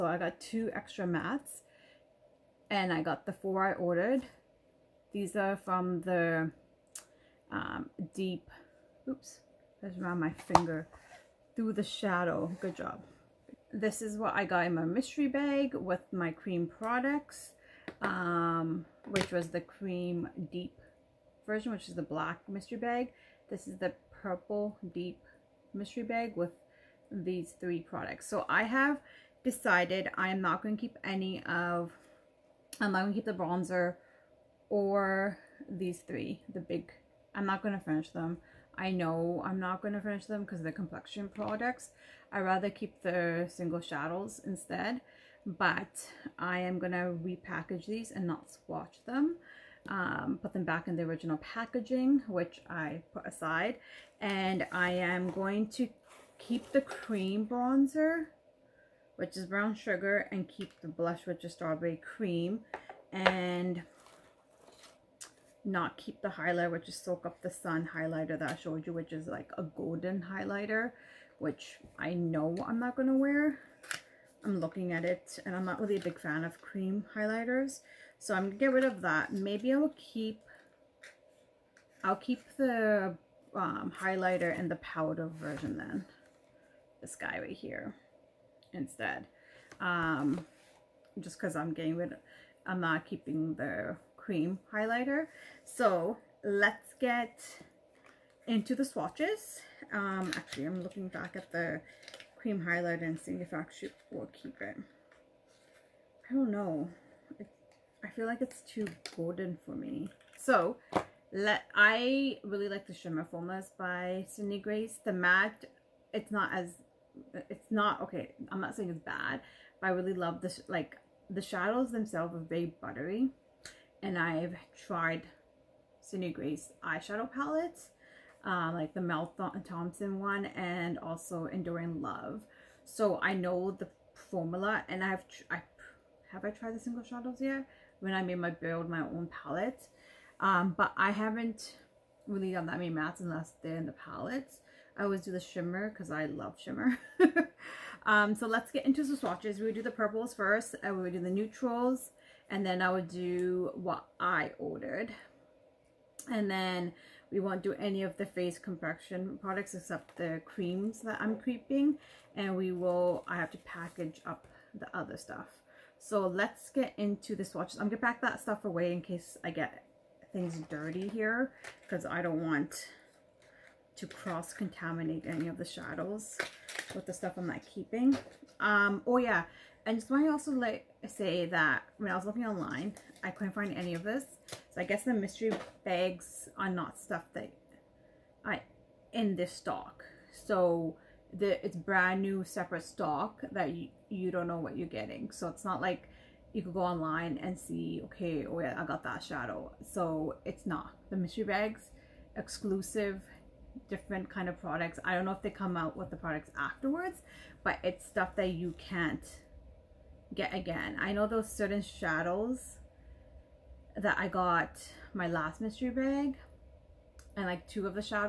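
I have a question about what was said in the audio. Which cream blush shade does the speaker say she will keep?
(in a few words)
Strawberry Cream.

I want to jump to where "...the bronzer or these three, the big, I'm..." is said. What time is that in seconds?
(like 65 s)
33 s.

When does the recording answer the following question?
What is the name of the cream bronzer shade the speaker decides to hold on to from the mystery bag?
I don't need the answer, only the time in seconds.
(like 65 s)
59 s.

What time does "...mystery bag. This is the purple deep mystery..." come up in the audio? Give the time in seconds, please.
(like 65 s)
22 s.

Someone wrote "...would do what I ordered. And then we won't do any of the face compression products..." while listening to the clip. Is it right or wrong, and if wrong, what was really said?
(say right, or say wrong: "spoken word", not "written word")
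right.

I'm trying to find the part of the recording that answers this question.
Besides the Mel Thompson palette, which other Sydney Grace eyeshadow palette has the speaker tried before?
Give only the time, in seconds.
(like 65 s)
131 s.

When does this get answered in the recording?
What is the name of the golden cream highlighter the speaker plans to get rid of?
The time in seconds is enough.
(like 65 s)
66 s.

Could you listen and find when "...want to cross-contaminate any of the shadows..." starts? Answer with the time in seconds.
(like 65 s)
172 s.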